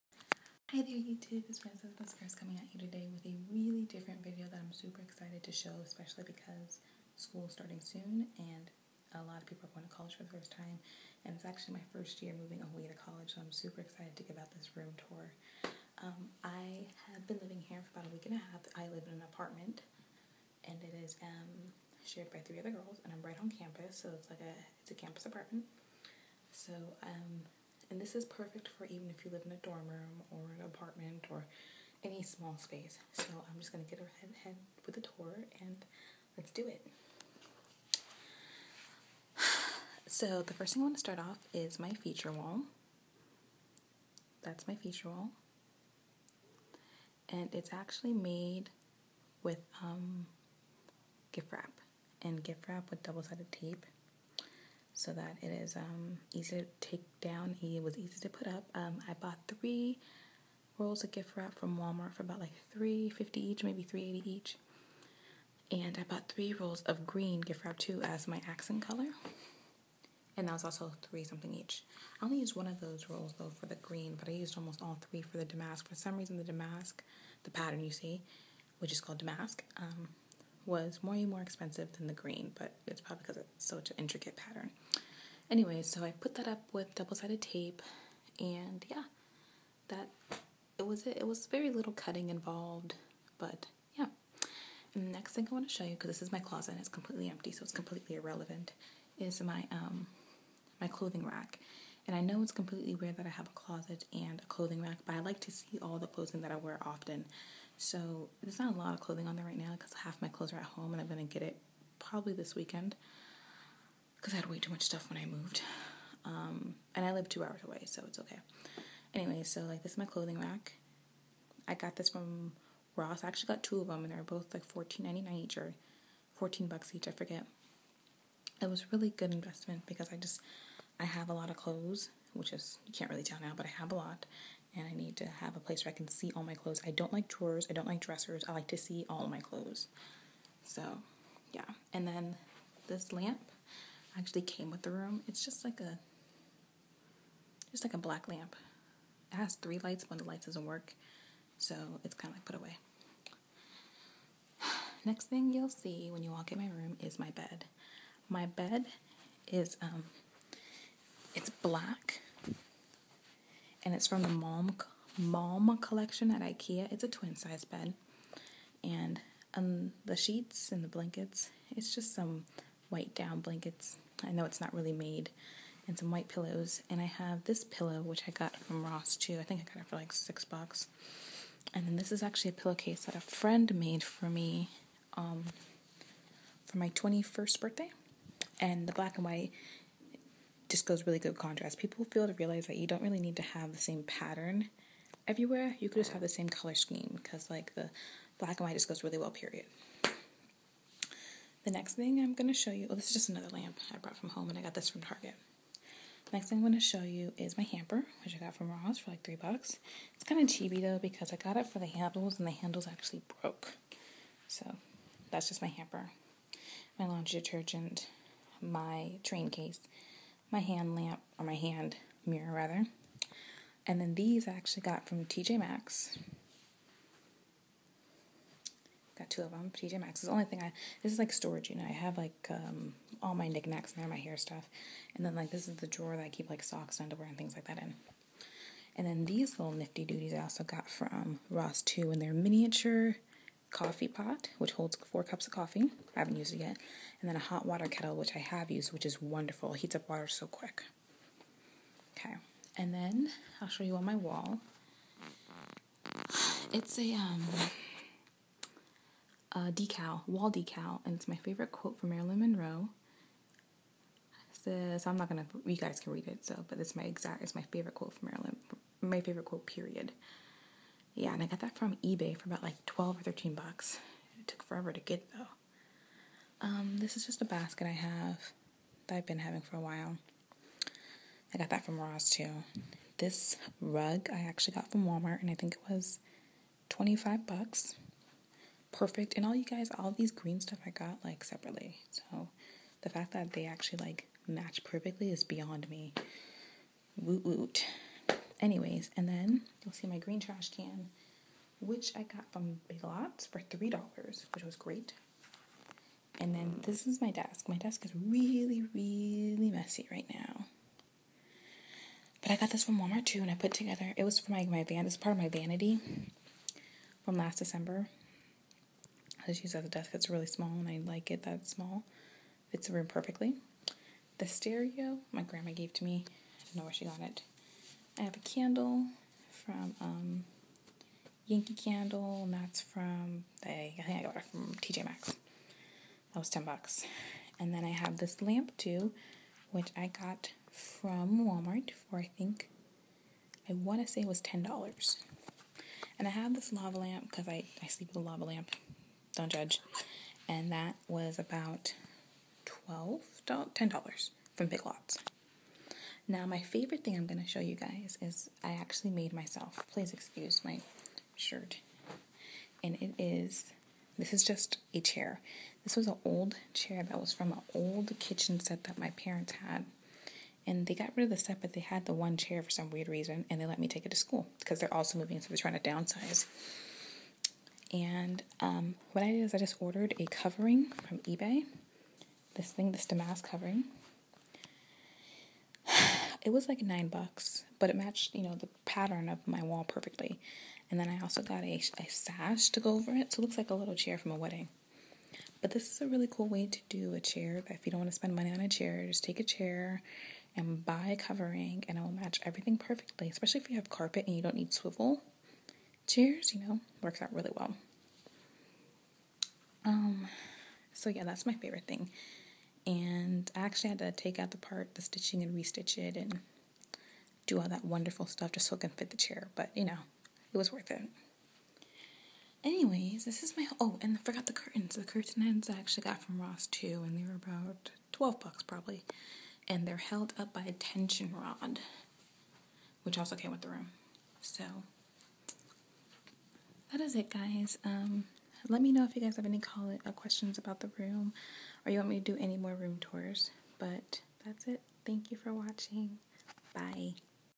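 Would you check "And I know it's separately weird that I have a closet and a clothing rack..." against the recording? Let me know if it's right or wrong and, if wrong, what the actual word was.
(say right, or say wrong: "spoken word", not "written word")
wrong: "completely", not "separately".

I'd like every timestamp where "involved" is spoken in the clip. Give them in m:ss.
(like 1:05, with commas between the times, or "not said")
1:32.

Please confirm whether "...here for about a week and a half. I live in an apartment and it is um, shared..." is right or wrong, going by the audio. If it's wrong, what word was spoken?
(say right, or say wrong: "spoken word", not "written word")
right.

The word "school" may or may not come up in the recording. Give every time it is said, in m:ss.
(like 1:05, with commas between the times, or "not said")
0:07, 6:14.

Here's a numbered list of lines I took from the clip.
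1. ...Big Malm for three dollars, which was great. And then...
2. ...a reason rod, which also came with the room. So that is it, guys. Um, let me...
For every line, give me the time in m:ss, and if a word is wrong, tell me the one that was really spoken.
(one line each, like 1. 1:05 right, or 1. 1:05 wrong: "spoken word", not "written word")
1. 5:02 wrong: "Lots", not "Malm"
2. 7:10 wrong: "tension", not "reason".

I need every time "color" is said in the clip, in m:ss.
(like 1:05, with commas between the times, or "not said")
1:08, 3:16.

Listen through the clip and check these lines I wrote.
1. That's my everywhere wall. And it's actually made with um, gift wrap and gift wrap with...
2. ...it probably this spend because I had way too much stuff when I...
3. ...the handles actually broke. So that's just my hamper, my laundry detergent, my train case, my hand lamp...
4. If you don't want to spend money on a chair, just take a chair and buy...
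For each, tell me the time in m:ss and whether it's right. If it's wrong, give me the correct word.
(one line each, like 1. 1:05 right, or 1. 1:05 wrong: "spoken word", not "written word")
1. 0:44 wrong: "feature", not "everywhere"
2. 1:51 wrong: "weekend", not "spend"
3. 3:32 right
4. 6:37 right.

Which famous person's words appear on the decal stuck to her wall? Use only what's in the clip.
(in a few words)
Marilyn Monroe.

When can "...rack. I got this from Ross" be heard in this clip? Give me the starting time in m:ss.
2:00.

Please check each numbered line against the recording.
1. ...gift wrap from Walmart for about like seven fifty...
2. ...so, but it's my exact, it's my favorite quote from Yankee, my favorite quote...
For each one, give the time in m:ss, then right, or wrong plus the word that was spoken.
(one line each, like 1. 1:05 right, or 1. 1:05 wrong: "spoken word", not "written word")
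1. 1:01 wrong: "three", not "seven"
2. 4:26 wrong: "Marilyn", not "Yankee".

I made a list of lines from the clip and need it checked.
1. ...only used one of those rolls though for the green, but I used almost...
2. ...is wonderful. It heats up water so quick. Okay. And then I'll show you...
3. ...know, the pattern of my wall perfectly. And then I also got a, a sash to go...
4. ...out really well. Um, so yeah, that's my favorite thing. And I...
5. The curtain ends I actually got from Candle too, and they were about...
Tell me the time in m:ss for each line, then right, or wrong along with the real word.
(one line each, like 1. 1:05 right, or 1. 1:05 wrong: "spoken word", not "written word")
1. 1:12 right
2. 4:09 right
3. 6:28 right
4. 6:47 right
5. 7:04 wrong: "Ross", not "Candle".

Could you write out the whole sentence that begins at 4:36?
Um, this is just a basket I have that I've been having for a while.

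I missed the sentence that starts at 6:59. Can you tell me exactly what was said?
But you know, it was worth it.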